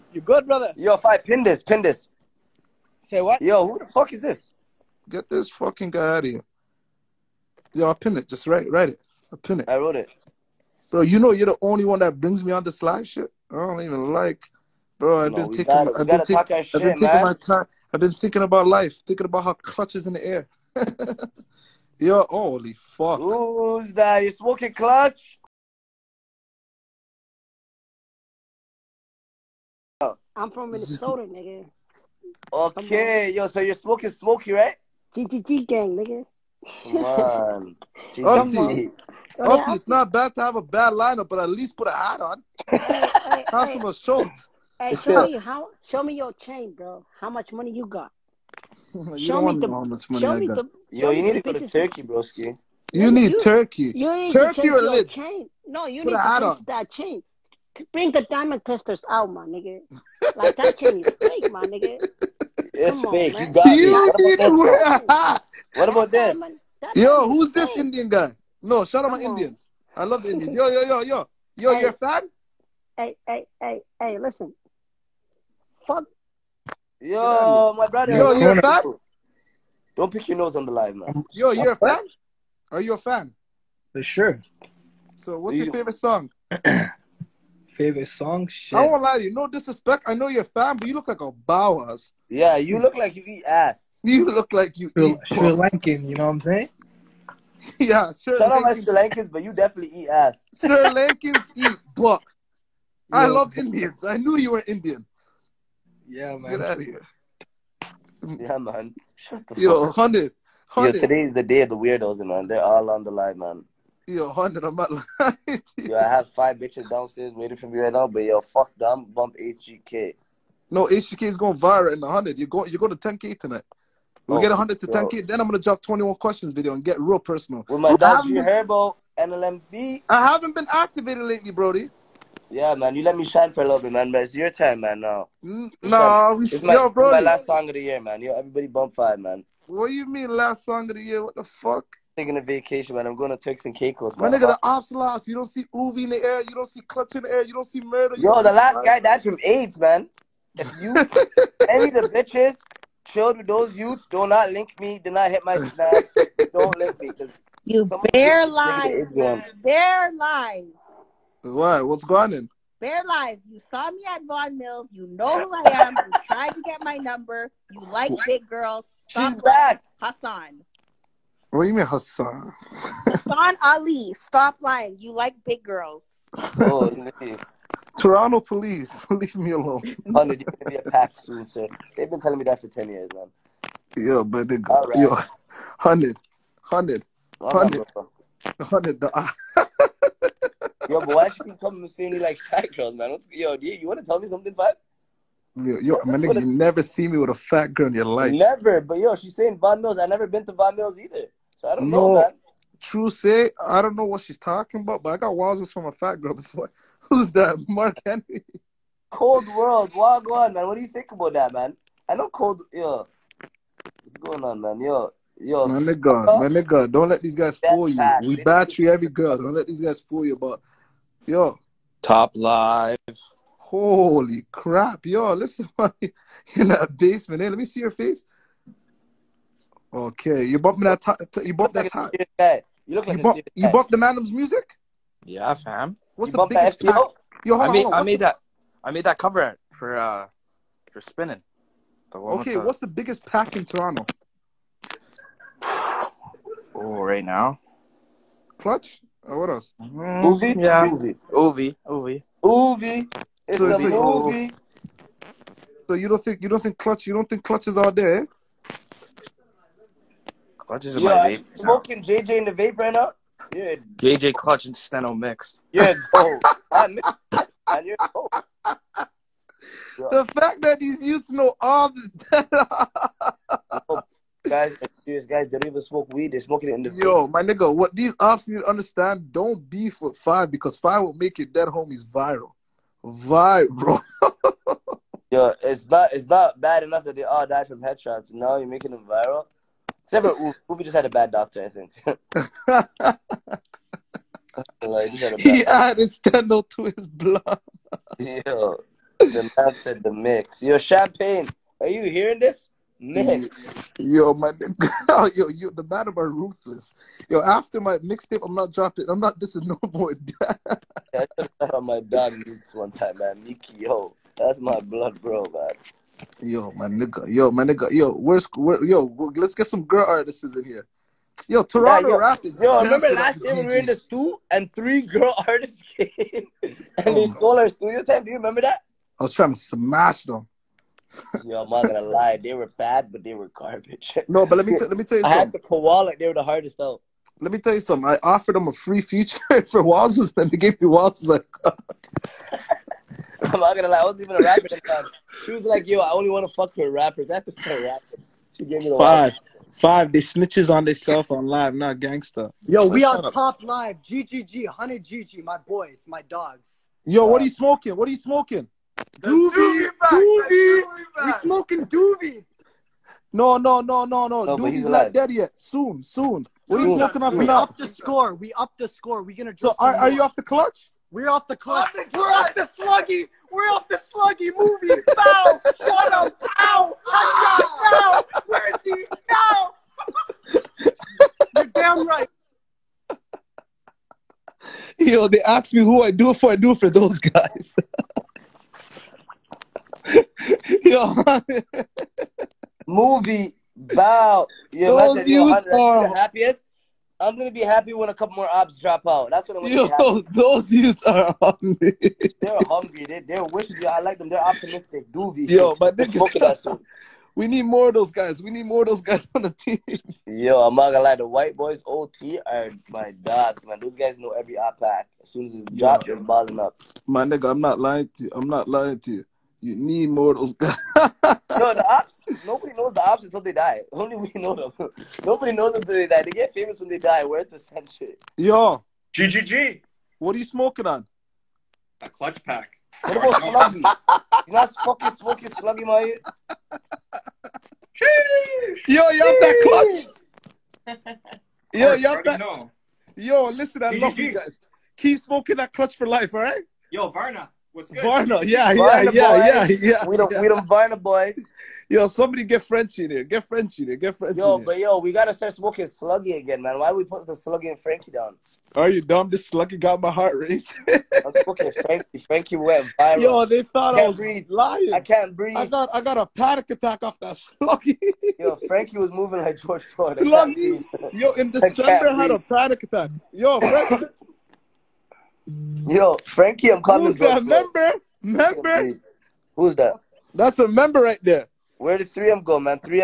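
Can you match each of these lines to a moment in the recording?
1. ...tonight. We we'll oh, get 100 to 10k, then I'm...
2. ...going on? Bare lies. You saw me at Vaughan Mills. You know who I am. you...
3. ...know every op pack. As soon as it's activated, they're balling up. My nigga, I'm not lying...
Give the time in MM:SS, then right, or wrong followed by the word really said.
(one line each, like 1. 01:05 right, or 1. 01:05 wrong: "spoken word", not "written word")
1. 02:03 right
2. 02:42 right
3. 06:54 wrong: "dropped", not "activated".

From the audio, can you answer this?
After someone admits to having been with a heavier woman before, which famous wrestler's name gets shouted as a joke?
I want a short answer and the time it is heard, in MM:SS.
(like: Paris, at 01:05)
Mark Henry, at 03:27.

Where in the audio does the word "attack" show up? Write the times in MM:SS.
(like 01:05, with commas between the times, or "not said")
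07:46, 07:52.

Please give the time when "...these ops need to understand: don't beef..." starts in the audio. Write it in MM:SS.
04:37.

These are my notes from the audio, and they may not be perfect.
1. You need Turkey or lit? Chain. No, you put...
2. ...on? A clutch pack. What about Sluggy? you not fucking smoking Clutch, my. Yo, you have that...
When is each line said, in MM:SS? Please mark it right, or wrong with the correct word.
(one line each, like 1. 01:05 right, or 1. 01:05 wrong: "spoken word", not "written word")
1. 00:53 right
2. 07:10 wrong: "Sluggy", not "Clutch".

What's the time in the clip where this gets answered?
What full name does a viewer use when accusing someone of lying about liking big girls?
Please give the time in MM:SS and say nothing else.
02:52.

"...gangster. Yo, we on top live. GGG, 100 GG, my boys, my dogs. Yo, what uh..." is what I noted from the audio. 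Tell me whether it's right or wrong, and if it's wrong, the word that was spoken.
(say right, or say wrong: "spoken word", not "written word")
right.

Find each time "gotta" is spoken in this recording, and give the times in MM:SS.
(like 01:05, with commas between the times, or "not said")
00:15, 07:35.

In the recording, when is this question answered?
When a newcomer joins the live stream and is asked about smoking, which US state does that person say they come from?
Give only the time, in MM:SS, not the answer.
00:30.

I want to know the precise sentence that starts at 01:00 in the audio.
Like that chain is fake, my nigga.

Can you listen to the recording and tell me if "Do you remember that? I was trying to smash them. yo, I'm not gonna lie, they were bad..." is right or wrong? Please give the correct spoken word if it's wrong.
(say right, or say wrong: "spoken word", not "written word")
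right.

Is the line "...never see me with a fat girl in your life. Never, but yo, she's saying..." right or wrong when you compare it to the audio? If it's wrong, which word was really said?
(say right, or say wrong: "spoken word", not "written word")
right.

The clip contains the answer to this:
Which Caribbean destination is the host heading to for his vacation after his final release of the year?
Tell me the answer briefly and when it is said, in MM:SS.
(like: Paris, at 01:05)
Turks and Caicos, at 02:23.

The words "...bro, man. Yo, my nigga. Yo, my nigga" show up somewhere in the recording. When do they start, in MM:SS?
05:15.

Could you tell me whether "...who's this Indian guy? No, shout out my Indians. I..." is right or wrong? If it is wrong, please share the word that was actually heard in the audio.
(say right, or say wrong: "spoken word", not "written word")
right.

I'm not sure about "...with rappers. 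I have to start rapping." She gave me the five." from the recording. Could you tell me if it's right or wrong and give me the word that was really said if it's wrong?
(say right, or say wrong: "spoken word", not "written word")
right.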